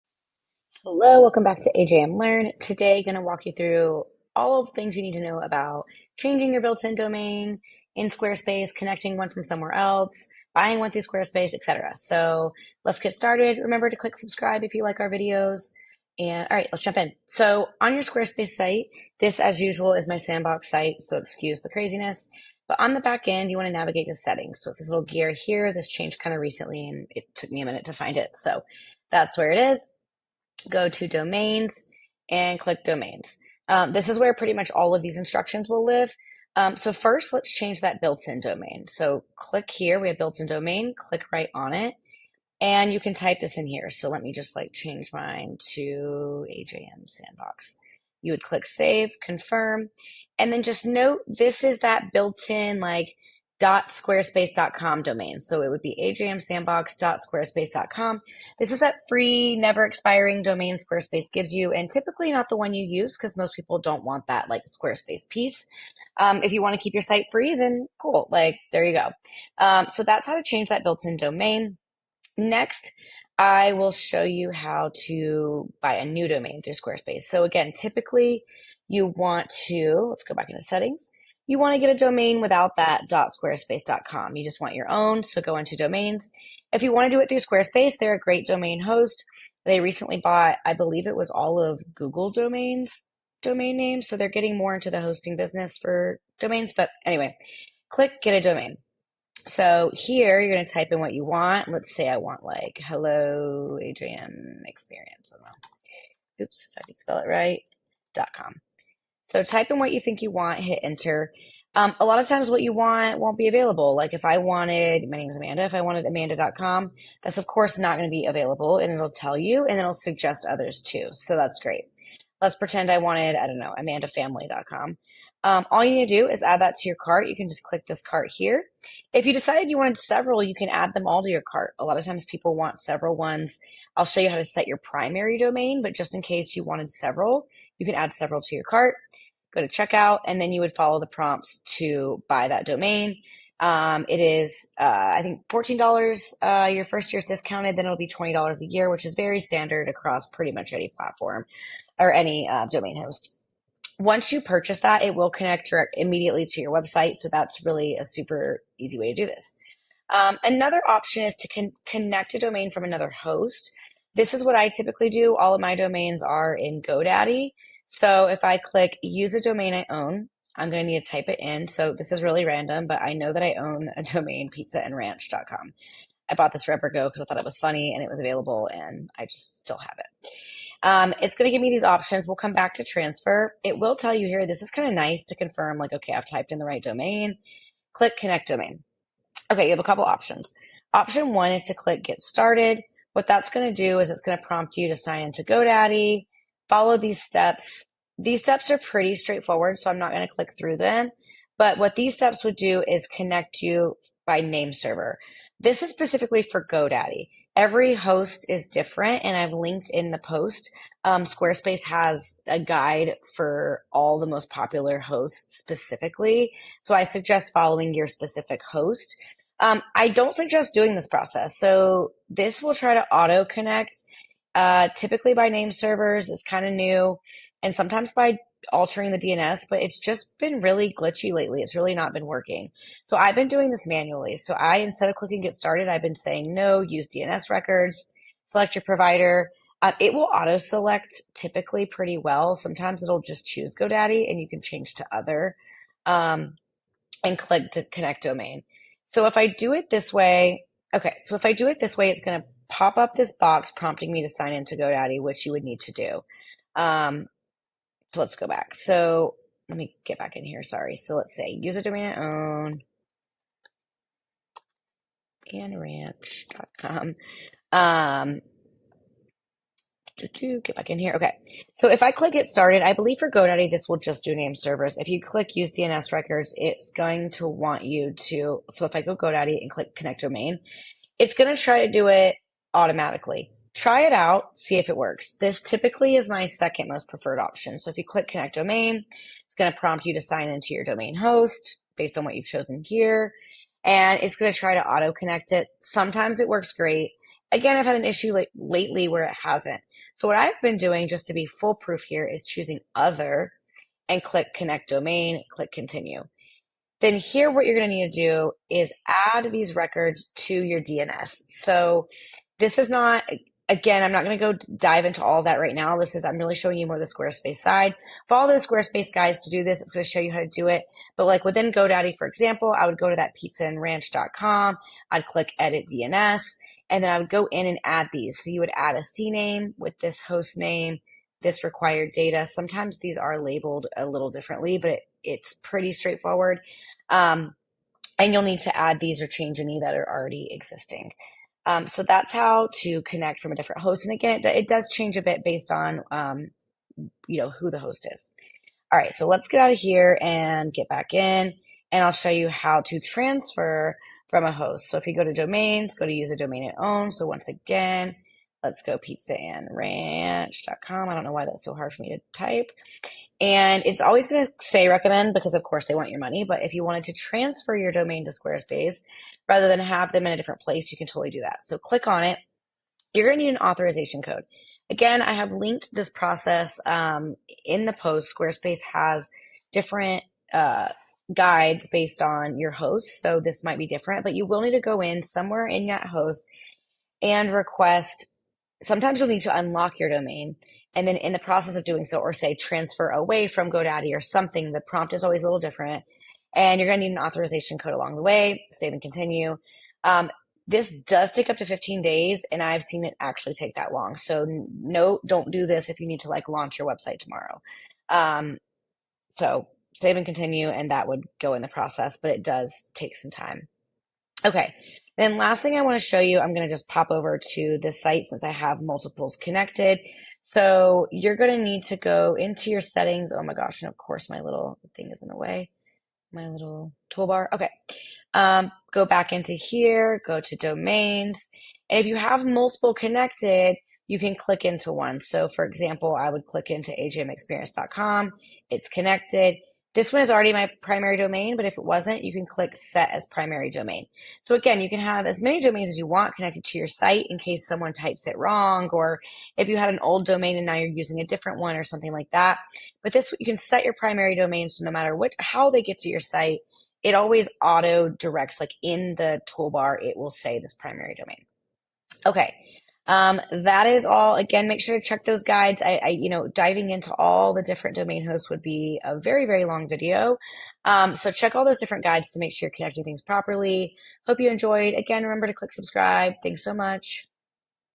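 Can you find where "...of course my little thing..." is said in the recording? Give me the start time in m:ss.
7:03.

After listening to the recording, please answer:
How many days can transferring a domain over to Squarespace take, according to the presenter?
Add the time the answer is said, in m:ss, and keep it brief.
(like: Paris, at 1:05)
15 days, at 6:41.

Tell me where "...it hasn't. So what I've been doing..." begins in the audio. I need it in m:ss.
4:59.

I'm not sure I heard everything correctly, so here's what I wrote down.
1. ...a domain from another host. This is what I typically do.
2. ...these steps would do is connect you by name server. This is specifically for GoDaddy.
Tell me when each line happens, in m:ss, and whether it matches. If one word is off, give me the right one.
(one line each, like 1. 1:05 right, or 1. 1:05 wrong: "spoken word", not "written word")
1. 2:42 right
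2. 3:21 right.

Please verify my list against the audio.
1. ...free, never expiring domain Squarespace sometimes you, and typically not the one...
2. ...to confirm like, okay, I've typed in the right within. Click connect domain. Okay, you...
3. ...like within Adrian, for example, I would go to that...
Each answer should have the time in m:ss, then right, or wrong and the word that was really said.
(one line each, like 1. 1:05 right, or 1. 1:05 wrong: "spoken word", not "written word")
1. 0:59 wrong: "gives", not "sometimes"
2. 3:05 wrong: "domain", not "within"
3. 5:21 wrong: "GoDaddy", not "Adrian".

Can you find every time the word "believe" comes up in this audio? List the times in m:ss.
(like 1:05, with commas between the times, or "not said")
1:30, 4:32.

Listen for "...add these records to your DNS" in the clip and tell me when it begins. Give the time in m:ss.
5:09.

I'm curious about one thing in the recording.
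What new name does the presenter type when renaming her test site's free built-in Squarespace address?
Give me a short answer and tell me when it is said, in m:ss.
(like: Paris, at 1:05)
AJM Sandbox, at 0:46.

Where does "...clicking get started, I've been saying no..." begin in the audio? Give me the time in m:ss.
3:55.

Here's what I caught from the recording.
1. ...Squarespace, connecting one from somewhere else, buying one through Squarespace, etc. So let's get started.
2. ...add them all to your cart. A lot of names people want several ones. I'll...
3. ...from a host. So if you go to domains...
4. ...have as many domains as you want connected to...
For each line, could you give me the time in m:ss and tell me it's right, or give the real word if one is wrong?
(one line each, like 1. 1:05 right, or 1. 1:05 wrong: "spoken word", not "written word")
1. 0:08 right
2. 2:10 wrong: "times", not "names"
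3. 5:54 right
4. 7:25 right.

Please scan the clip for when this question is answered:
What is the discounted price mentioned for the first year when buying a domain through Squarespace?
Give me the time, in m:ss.
2:25.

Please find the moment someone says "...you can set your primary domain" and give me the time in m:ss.
7:33.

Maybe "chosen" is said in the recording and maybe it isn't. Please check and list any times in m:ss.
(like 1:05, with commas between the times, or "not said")
4:52.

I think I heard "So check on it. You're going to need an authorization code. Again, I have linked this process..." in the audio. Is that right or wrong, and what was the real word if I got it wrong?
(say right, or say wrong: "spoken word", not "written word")
wrong: "click", not "check".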